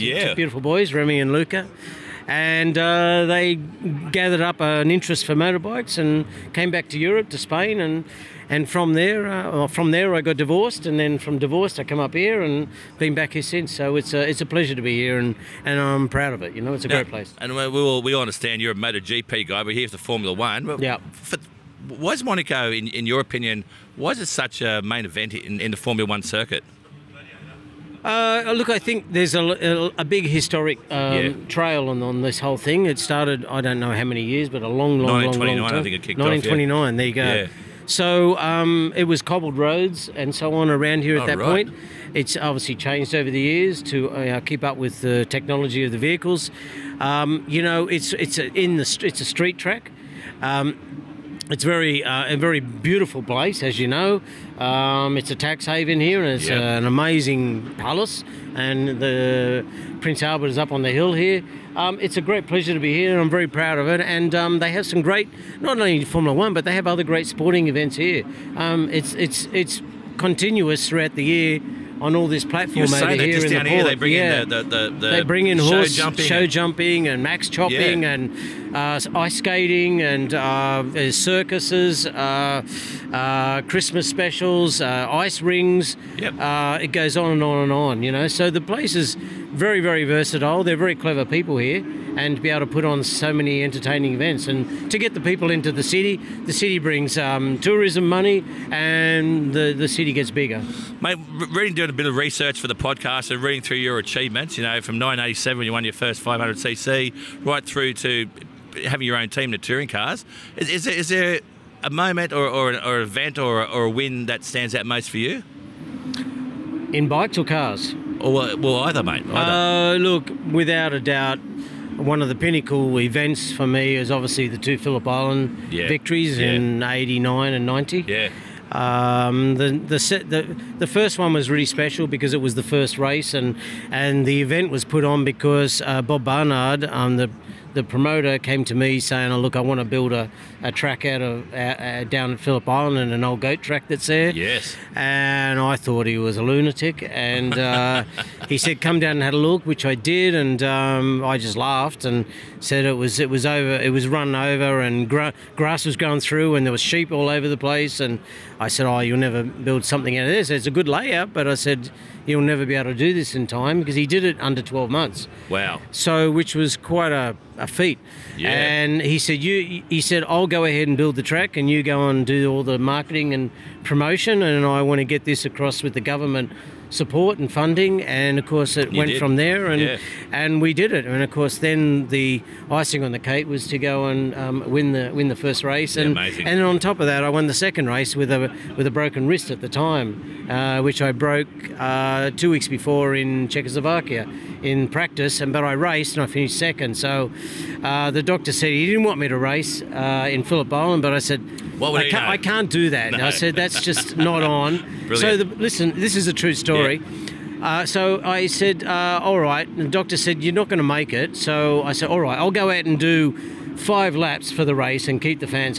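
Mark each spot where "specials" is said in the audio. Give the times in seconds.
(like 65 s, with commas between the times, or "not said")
84 s, 131 s.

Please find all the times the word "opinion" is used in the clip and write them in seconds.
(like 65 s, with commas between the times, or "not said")
23 s.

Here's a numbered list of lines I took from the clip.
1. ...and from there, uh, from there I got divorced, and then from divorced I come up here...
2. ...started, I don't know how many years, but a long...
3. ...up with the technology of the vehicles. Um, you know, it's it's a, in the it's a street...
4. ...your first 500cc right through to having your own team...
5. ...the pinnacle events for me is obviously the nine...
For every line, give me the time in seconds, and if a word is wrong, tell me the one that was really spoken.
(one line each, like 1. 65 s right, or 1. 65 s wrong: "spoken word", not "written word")
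1. 8 s right
2. 32 s right
3. 44 s right
4. 105 s right
5. 122 s wrong: "two", not "nine".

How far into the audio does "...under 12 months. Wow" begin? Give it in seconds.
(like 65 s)
164 s.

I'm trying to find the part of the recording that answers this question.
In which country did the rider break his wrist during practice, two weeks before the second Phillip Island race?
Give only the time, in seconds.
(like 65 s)
193 s.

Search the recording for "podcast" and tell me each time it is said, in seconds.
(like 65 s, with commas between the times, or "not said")
102 s.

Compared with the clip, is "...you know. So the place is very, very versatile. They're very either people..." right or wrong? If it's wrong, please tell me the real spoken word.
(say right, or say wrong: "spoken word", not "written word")
wrong: "clever", not "either".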